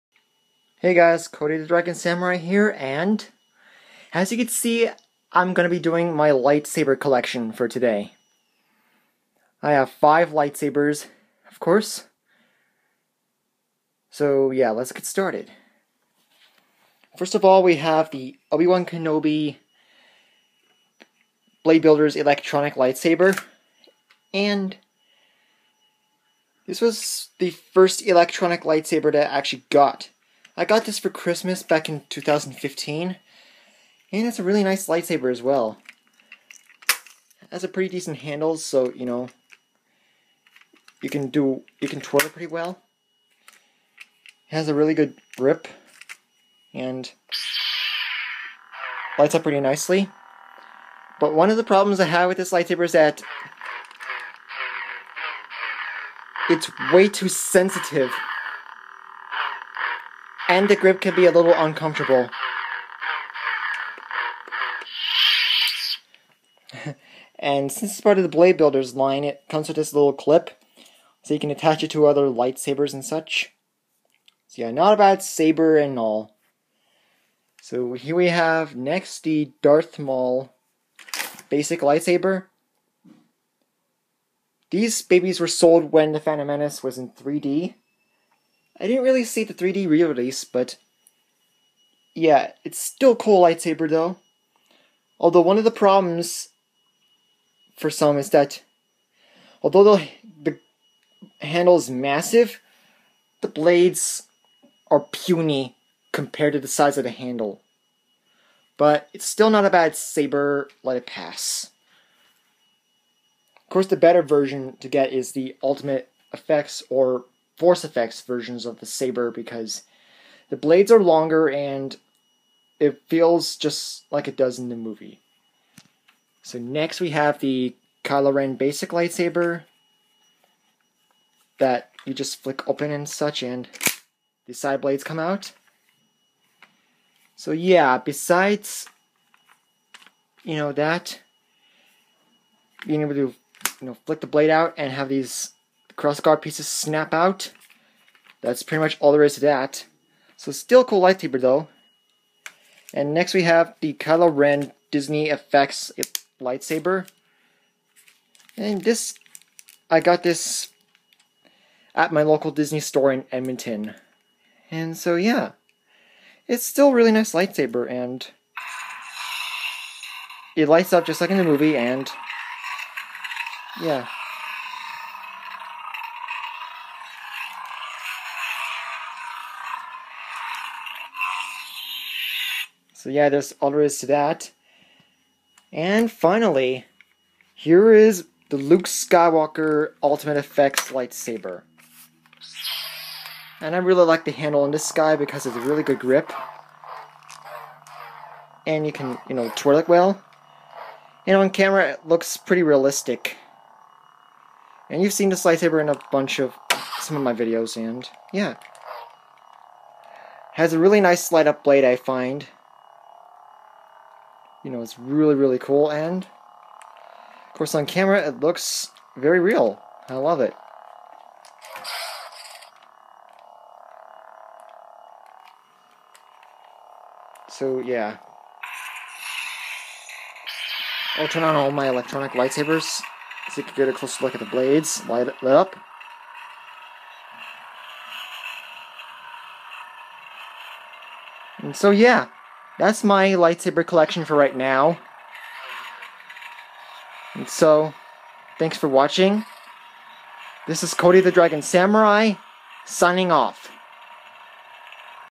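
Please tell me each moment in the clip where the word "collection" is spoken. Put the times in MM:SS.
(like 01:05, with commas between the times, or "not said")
00:06, 04:03.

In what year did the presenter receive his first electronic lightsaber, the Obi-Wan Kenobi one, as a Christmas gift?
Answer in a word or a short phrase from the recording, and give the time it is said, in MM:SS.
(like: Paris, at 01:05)
2015, at 00:32.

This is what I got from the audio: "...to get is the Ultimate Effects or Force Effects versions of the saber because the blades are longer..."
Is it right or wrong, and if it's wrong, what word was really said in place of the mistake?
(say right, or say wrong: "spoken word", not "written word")
right.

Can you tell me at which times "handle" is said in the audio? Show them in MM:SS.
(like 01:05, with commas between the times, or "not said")
00:38, 01:41, 01:47, 03:14.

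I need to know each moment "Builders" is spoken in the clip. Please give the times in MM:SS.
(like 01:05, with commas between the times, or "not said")
00:21, 01:08.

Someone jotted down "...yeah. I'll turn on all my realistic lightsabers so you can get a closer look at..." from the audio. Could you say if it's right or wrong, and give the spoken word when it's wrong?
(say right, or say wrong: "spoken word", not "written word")
wrong: "electronic", not "realistic".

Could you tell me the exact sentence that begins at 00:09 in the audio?
I have five lightsabers, of course.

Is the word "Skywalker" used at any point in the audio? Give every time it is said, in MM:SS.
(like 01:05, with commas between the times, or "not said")
03:08.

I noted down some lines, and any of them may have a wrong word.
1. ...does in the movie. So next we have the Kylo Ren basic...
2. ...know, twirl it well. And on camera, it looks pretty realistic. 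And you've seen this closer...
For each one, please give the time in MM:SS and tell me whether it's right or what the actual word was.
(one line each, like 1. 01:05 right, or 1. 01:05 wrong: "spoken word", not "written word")
1. 02:04 right
2. 03:19 wrong: "lightsaber", not "closer".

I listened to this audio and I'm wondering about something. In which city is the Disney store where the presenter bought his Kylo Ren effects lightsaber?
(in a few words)
Edmonton.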